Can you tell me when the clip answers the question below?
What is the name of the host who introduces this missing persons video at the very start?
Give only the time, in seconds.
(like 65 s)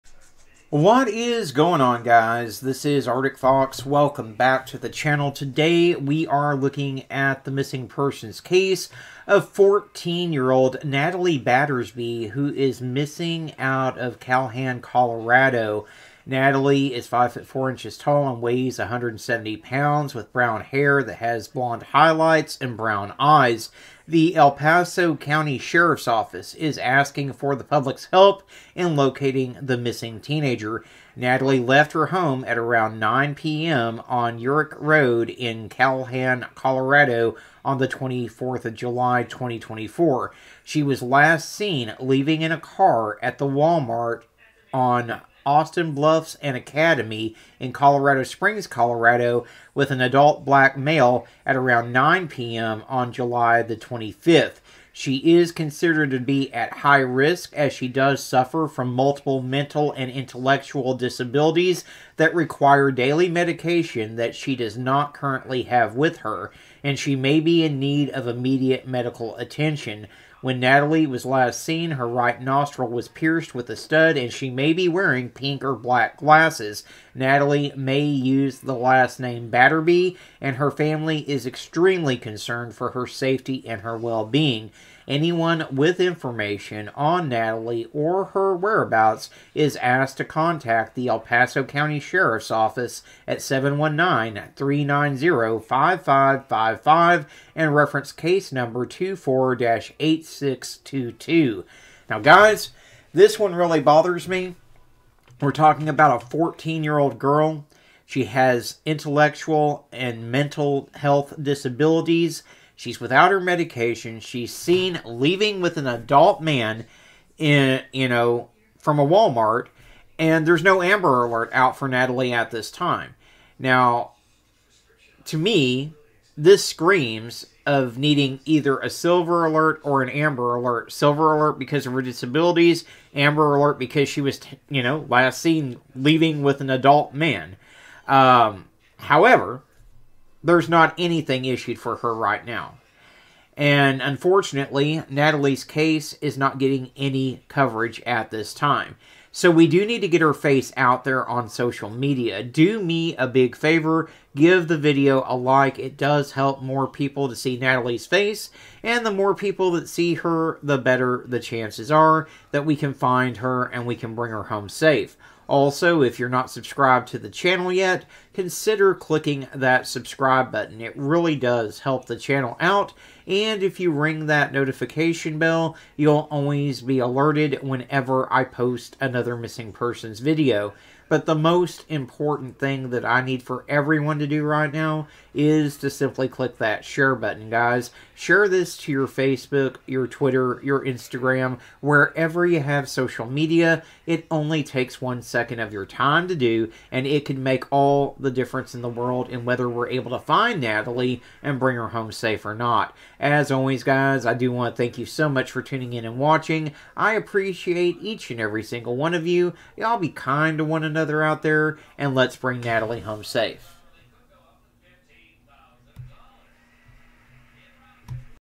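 3 s.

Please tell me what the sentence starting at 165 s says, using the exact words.
Also, if you're not subscribed to the channel yet, consider clicking that subscribe button.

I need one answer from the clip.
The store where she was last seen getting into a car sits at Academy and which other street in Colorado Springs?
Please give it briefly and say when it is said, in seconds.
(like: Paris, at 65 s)
Austin Bluffs, at 45 s.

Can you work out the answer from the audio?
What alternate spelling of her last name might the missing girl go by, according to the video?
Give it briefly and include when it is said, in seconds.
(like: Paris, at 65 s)
Batterby, at 79 s.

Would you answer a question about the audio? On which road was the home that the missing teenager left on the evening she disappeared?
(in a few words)
Urich Road.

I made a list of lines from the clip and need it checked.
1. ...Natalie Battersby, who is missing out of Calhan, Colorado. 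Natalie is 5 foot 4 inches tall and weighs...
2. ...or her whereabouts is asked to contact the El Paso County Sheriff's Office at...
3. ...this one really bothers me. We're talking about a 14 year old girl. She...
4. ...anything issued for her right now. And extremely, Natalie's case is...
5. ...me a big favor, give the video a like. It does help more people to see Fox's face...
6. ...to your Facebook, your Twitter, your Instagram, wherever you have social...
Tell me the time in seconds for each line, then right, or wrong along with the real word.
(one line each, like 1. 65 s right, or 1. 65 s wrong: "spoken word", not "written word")
1. 10 s right
2. 87 s right
3. 103 s right
4. 140 s wrong: "unfortunately", not "extremely"
5. 152 s wrong: "Natalie", not "Fox"
6. 188 s right.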